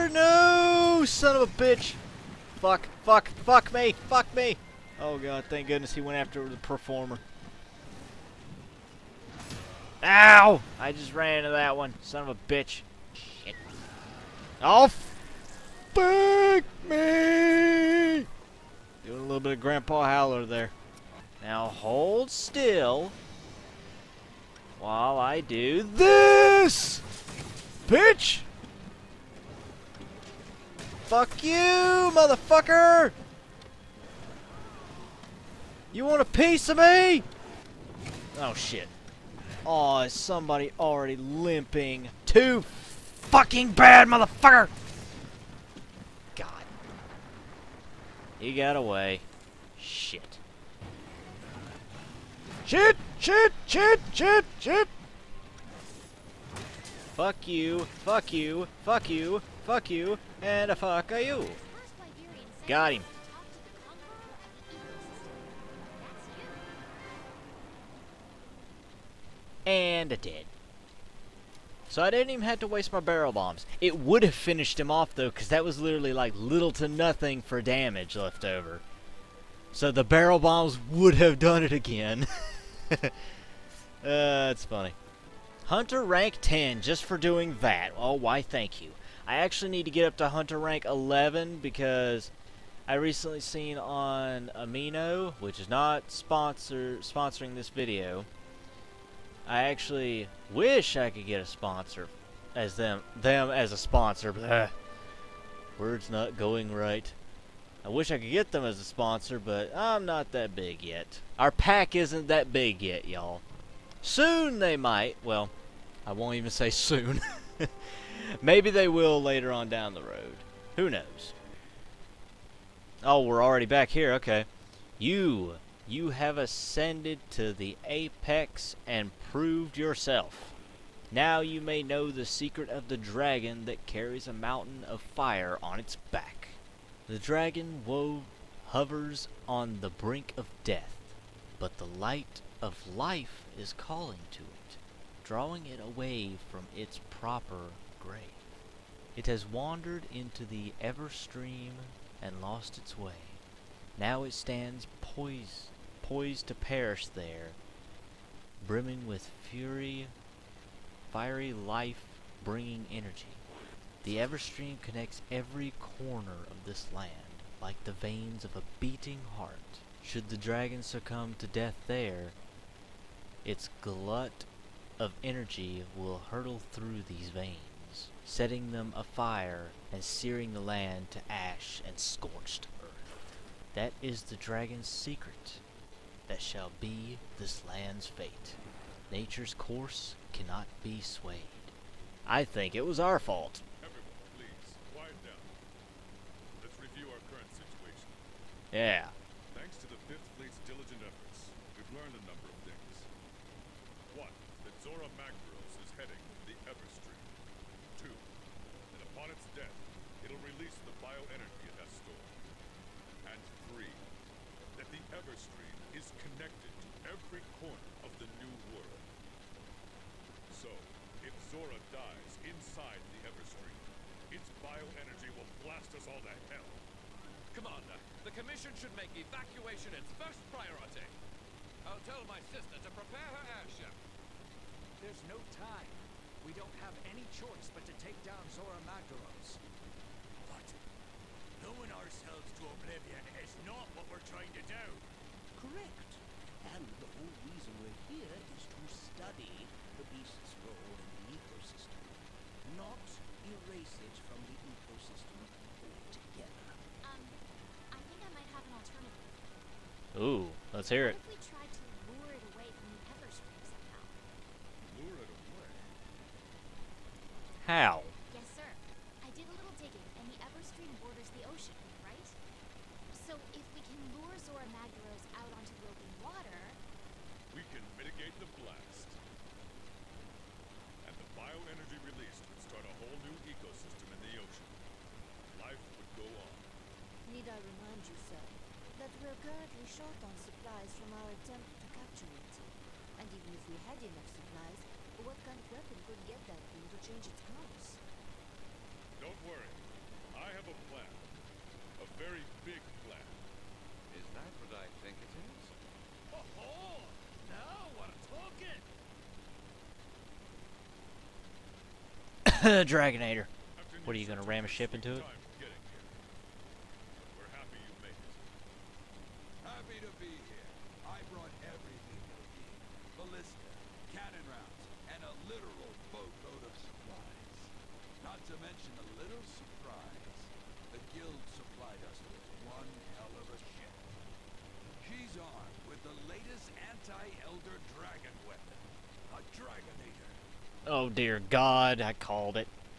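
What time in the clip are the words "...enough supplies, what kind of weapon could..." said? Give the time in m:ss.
4:53.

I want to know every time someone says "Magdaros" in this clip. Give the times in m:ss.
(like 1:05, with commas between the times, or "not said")
3:25, 3:58.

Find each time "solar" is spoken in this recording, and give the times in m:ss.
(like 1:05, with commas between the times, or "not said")
not said.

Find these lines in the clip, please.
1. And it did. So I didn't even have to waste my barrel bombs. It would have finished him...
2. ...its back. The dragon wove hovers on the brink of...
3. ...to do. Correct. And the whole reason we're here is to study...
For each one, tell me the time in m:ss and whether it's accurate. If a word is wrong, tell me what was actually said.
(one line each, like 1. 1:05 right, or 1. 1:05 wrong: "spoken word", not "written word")
1. 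1:09 right
2. 2:15 right
3. 4:04 right.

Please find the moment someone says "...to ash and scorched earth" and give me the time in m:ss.
3:01.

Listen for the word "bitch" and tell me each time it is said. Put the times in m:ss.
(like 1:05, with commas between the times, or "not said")
0:01, 0:12.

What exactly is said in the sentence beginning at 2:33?
Now it stands poised, poised to perish there, brimming with fury, fiery life bringing energy.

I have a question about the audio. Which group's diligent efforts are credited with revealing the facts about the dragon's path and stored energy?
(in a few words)
Fifth Fleet.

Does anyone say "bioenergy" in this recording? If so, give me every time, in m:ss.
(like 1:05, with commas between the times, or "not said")
3:31, 3:44.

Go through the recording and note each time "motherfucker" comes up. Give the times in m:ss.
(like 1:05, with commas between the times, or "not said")
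0:32, 0:44.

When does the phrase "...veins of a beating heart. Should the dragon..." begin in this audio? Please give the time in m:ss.
2:47.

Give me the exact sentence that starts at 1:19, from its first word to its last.
So the barrel bombs would have done it again.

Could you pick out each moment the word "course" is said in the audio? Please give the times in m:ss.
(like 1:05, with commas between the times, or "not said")
3:09, 4:57.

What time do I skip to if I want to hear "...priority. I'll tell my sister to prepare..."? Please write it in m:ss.
3:50.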